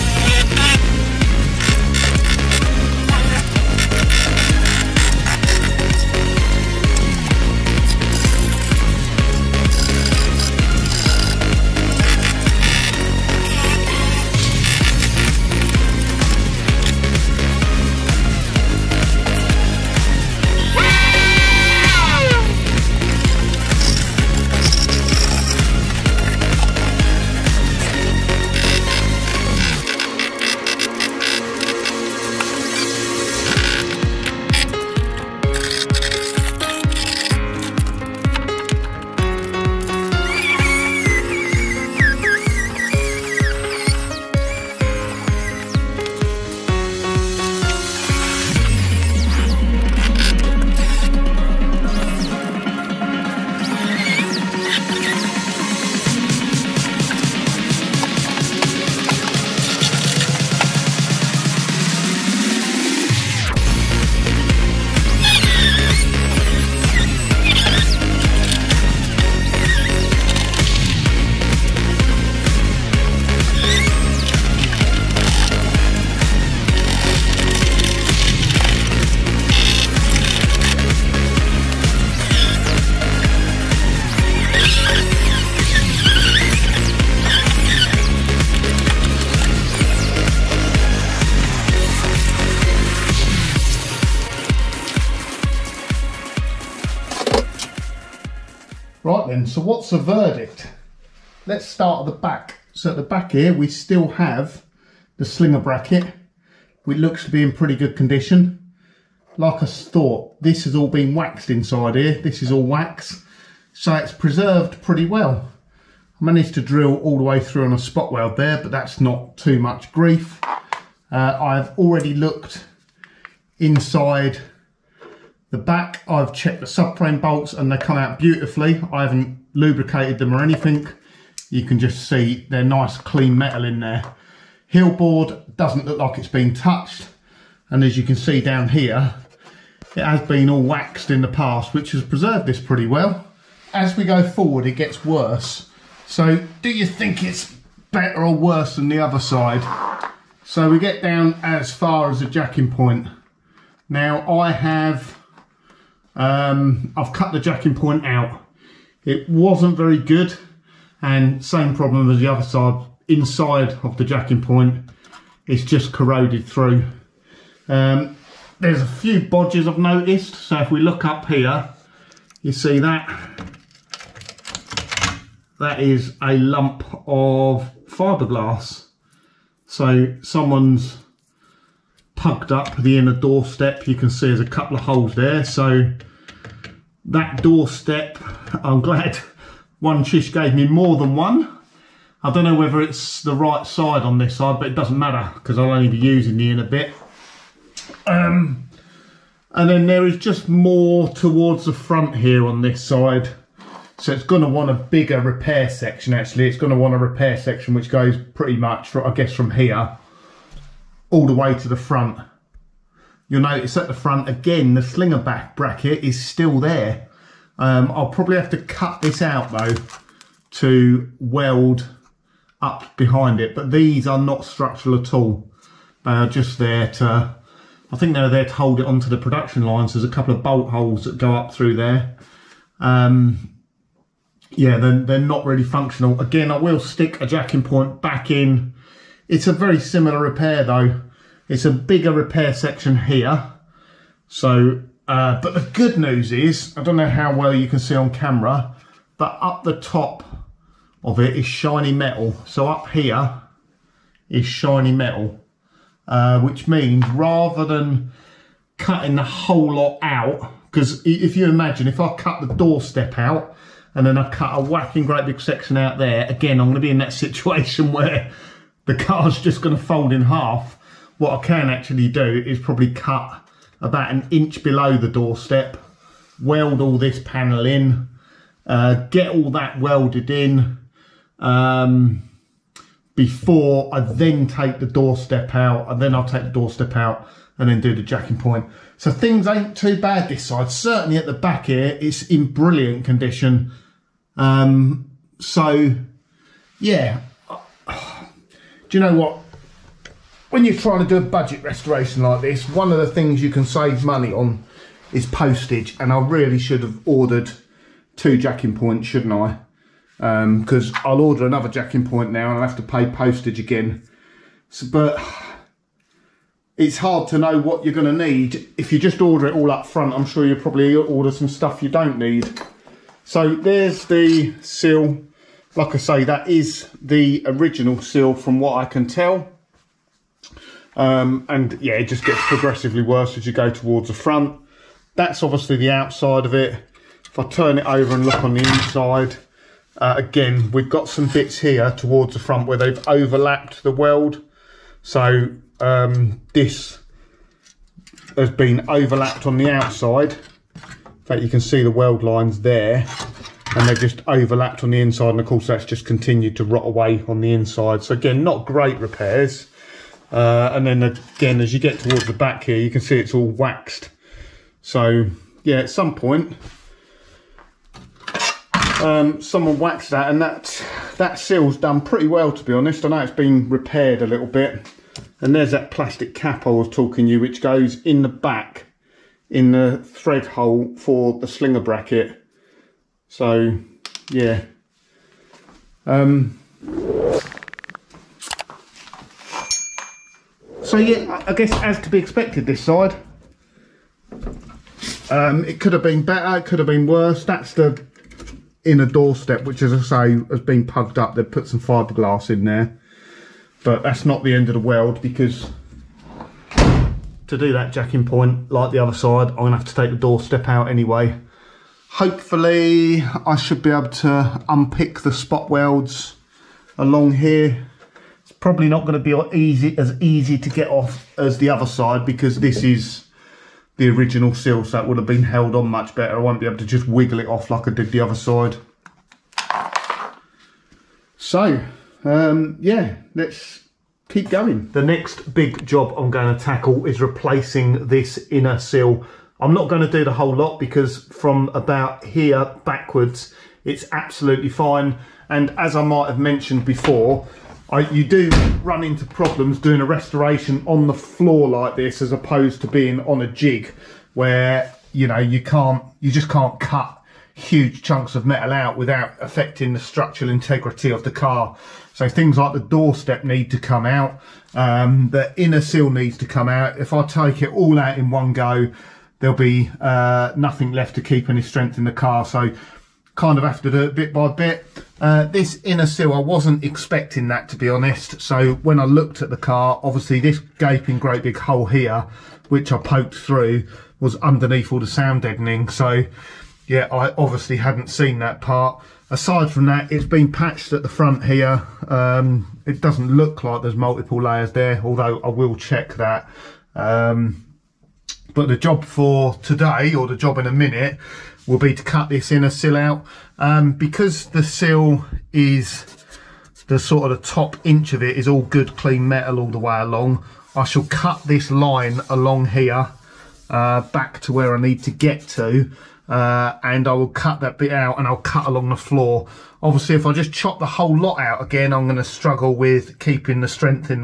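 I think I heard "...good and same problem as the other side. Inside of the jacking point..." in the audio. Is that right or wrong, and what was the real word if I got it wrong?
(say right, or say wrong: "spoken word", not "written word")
right.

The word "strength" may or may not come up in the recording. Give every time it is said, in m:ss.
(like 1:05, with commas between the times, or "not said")
7:51, 8:43.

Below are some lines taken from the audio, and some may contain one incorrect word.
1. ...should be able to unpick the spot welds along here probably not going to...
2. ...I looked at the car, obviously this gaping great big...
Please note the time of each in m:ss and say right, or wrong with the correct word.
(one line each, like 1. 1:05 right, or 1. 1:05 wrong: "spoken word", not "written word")
1. 6:53 right
2. 7:58 right.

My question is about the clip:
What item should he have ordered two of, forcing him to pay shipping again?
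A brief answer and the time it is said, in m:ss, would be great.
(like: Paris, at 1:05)
Jacking points, at 5:08.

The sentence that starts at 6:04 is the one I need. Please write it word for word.
So yeah, at some point, um, someone waxed that and that, that sill's done pretty well, to be honest.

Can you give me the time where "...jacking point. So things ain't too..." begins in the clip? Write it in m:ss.
4:48.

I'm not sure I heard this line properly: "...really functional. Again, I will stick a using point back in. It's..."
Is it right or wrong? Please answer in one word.
wrong.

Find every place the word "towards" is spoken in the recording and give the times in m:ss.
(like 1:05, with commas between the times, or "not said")
3:21, 5:33, 5:41, 6:01.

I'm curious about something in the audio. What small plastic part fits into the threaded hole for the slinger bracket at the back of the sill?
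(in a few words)
Plastic cap.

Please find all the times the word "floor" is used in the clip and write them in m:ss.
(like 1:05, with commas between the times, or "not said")
7:31, 8:38.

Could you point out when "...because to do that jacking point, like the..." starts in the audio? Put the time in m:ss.
6:45.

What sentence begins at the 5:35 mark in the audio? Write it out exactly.
That's obviously the outside of it.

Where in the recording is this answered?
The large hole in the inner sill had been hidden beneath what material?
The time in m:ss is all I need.
8:05.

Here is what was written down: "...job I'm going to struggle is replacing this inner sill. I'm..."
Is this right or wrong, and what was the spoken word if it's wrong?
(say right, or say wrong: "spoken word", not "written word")
wrong: "tackle", not "struggle".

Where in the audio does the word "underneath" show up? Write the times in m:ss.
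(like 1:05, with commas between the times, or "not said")
8:04.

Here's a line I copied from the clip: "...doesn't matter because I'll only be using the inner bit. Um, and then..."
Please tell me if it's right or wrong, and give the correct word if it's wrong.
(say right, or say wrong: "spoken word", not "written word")
right.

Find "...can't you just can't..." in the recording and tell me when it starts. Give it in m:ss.
7:35.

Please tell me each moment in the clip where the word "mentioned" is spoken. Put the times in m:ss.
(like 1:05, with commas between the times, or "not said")
7:26.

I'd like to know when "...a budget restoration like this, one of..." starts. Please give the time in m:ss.
5:01.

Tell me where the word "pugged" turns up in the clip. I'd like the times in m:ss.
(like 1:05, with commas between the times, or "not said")
3:02, 6:40.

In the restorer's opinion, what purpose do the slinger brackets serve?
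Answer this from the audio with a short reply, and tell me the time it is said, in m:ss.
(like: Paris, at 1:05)
To hold it onto the production lines, at 3:48.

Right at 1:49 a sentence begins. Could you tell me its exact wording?
Like I thought, this has all been waxed inside here.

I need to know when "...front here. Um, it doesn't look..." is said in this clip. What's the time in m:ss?
8:11.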